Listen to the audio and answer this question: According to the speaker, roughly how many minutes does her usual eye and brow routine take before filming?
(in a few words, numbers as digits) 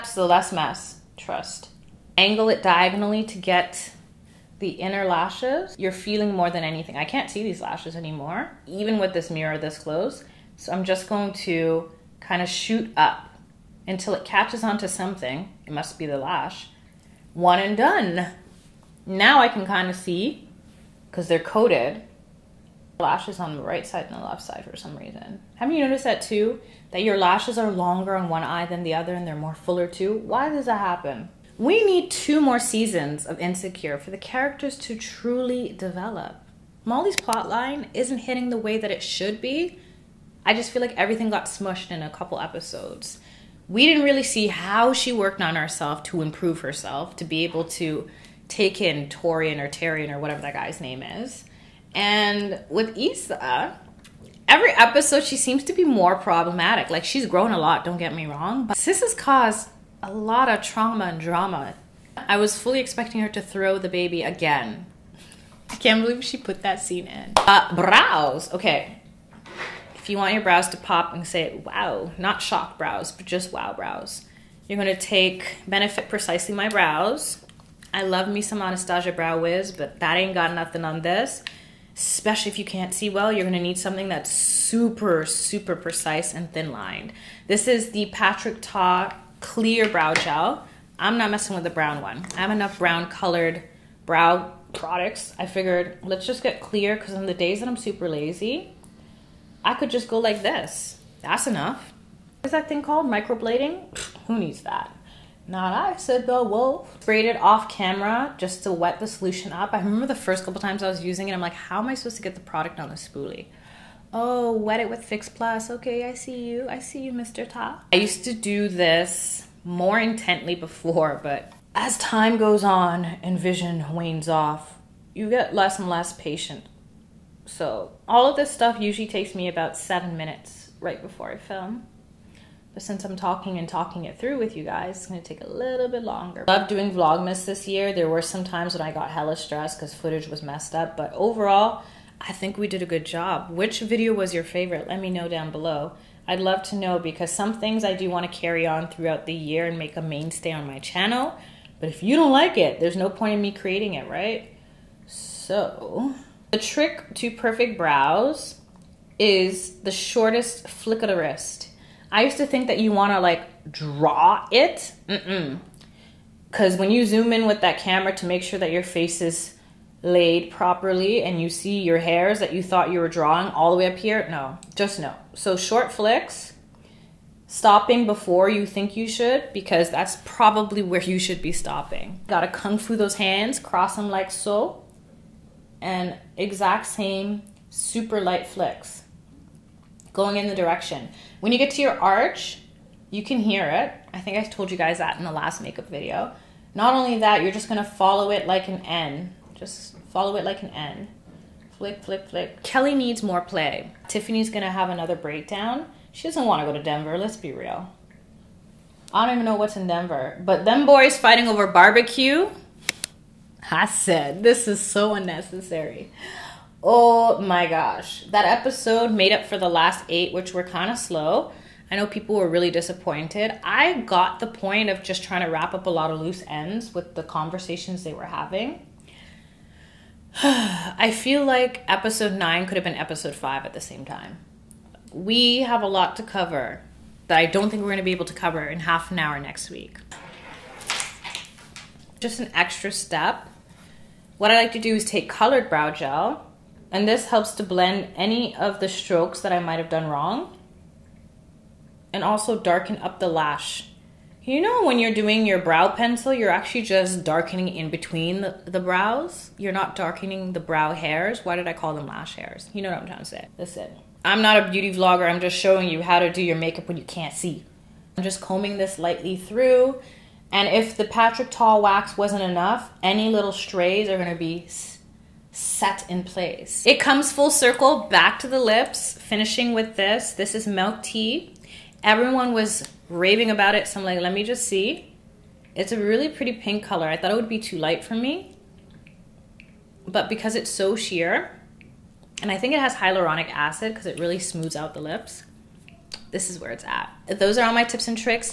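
7.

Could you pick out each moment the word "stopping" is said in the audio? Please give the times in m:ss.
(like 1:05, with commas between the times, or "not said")
2:57, 3:01.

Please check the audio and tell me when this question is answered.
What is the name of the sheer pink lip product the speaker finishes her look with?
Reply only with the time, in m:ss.
4:40.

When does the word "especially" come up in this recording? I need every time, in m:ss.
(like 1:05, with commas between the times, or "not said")
1:21.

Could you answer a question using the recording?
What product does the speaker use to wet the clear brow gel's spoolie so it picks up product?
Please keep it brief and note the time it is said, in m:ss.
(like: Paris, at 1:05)
Fix Plus, at 1:55.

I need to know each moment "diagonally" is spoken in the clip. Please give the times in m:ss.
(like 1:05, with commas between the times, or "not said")
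0:02.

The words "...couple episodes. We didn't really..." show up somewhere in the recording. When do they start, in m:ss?
0:42.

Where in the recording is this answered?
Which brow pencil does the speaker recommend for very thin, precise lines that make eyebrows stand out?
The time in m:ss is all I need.
1:15.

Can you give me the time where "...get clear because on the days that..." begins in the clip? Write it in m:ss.
1:36.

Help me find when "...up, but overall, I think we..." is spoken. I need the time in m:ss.
2:20.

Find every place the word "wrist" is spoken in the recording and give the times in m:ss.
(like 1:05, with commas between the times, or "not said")
2:41.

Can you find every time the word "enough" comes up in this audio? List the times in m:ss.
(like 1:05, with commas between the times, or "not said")
1:32, 1:41, 4:32.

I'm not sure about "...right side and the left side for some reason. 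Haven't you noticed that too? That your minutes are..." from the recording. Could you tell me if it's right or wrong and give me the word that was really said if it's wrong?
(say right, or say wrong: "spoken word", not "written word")
wrong: "lashes", not "minutes".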